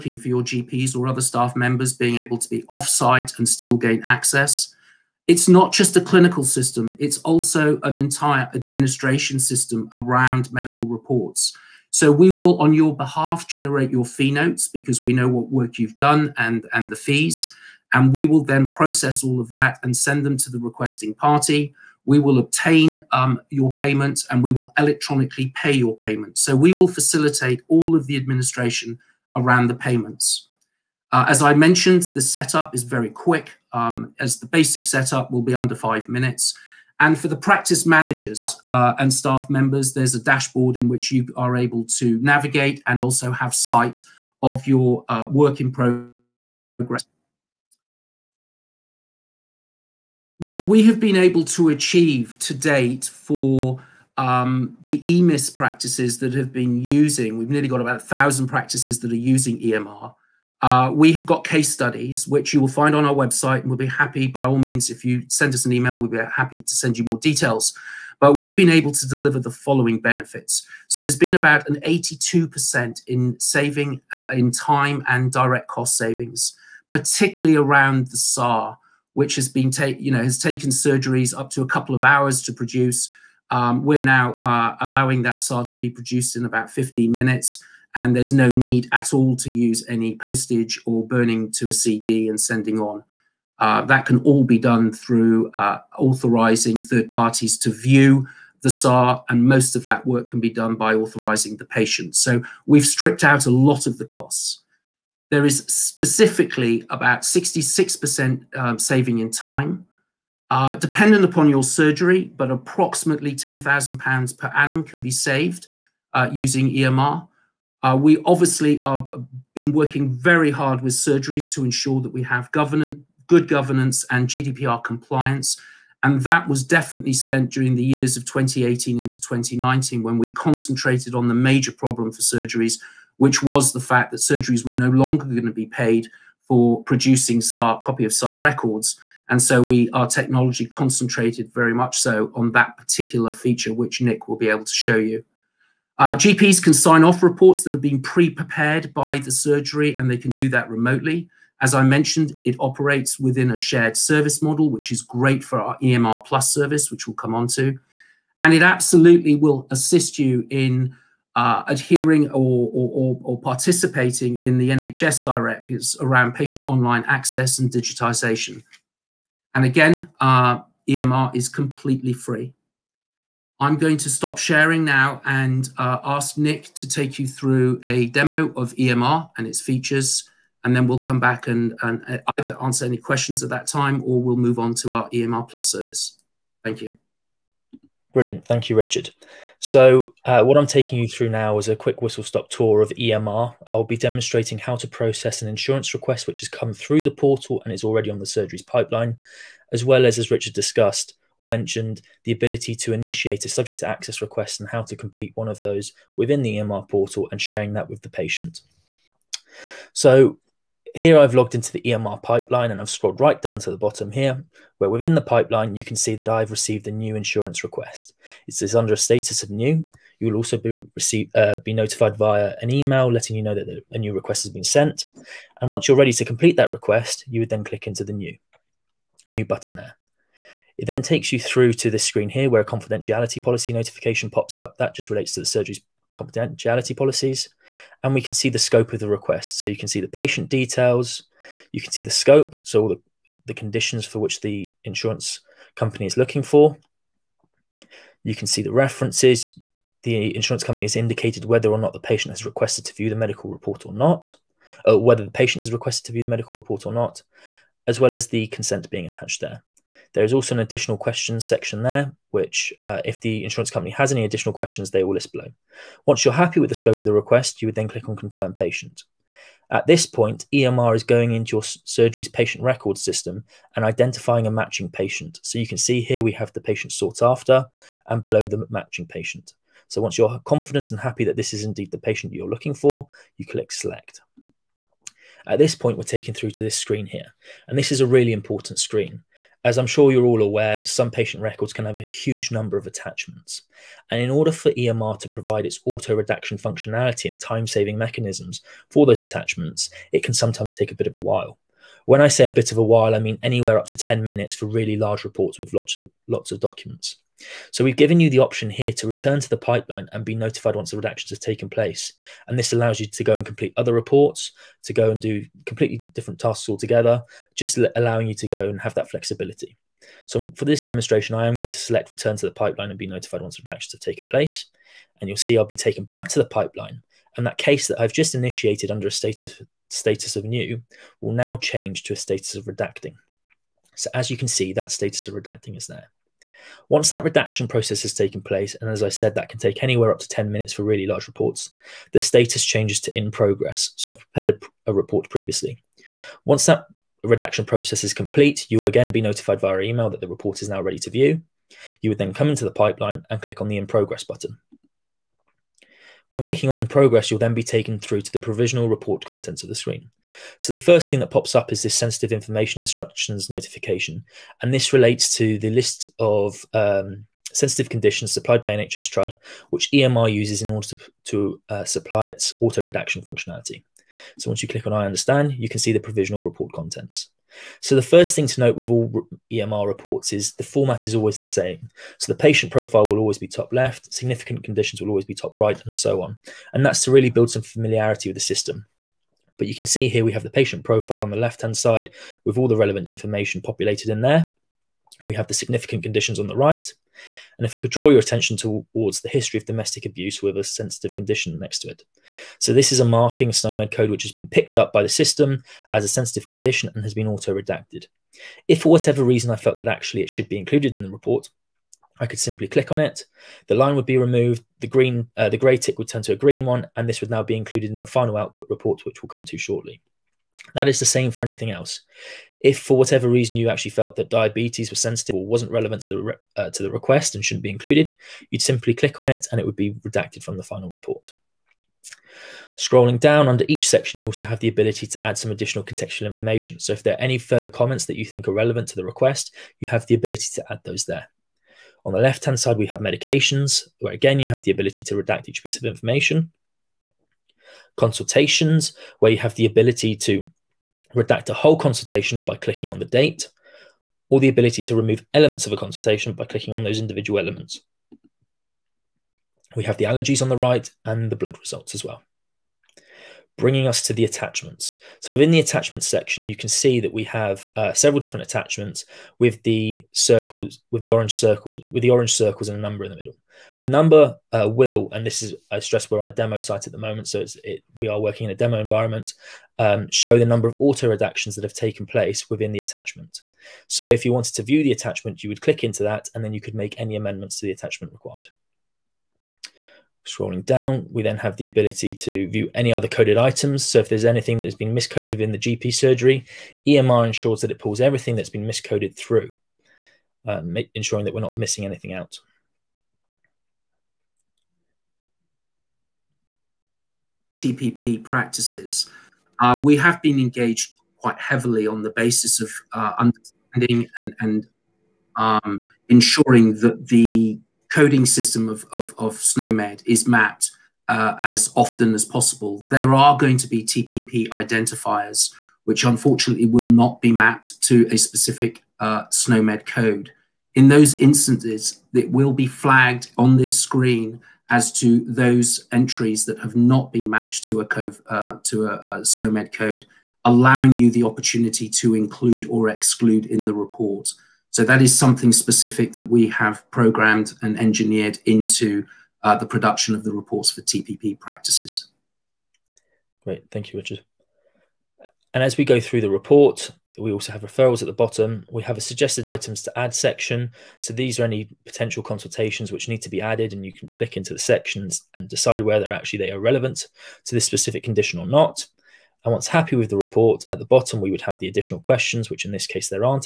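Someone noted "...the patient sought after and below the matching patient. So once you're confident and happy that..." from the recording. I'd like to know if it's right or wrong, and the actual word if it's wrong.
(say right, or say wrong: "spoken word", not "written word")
right.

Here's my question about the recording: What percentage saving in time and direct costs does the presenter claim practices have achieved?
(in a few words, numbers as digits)
82%.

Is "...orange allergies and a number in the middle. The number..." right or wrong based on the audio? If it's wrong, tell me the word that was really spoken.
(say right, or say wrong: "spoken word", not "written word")
wrong: "circles", not "allergies".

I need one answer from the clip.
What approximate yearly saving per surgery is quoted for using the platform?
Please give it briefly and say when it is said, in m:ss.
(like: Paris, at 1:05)
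£10,000, at 1:53.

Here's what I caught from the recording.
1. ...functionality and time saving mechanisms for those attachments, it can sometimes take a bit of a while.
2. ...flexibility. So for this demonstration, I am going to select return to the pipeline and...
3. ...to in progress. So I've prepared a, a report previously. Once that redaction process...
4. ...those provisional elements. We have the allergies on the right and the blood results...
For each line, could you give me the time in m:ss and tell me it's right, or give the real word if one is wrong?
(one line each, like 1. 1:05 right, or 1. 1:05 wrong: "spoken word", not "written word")
1. 4:56 right
2. 5:19 right
3. 5:43 right
4. 7:36 wrong: "individual", not "provisional".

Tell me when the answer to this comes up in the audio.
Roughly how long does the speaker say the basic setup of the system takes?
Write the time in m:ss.
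0:35.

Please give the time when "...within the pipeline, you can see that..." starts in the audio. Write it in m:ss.
3:34.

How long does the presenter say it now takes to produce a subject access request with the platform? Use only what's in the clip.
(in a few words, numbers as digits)
15 minutes.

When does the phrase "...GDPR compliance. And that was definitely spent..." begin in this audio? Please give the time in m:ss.
2:04.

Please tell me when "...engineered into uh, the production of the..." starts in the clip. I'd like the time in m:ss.
9:07.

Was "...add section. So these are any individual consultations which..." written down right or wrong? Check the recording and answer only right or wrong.
wrong.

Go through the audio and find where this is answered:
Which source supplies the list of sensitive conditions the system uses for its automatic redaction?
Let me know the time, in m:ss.
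6:08.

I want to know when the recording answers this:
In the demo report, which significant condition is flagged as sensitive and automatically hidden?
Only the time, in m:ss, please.
6:39.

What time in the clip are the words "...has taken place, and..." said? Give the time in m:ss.
5:38.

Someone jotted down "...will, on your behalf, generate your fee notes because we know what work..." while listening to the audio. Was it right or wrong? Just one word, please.
right.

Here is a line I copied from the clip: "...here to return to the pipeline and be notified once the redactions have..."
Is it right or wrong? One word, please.
right.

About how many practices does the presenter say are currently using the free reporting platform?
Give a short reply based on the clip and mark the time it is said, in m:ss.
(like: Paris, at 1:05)
about 1000, at 0:57.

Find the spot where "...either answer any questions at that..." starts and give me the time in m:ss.
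3:02.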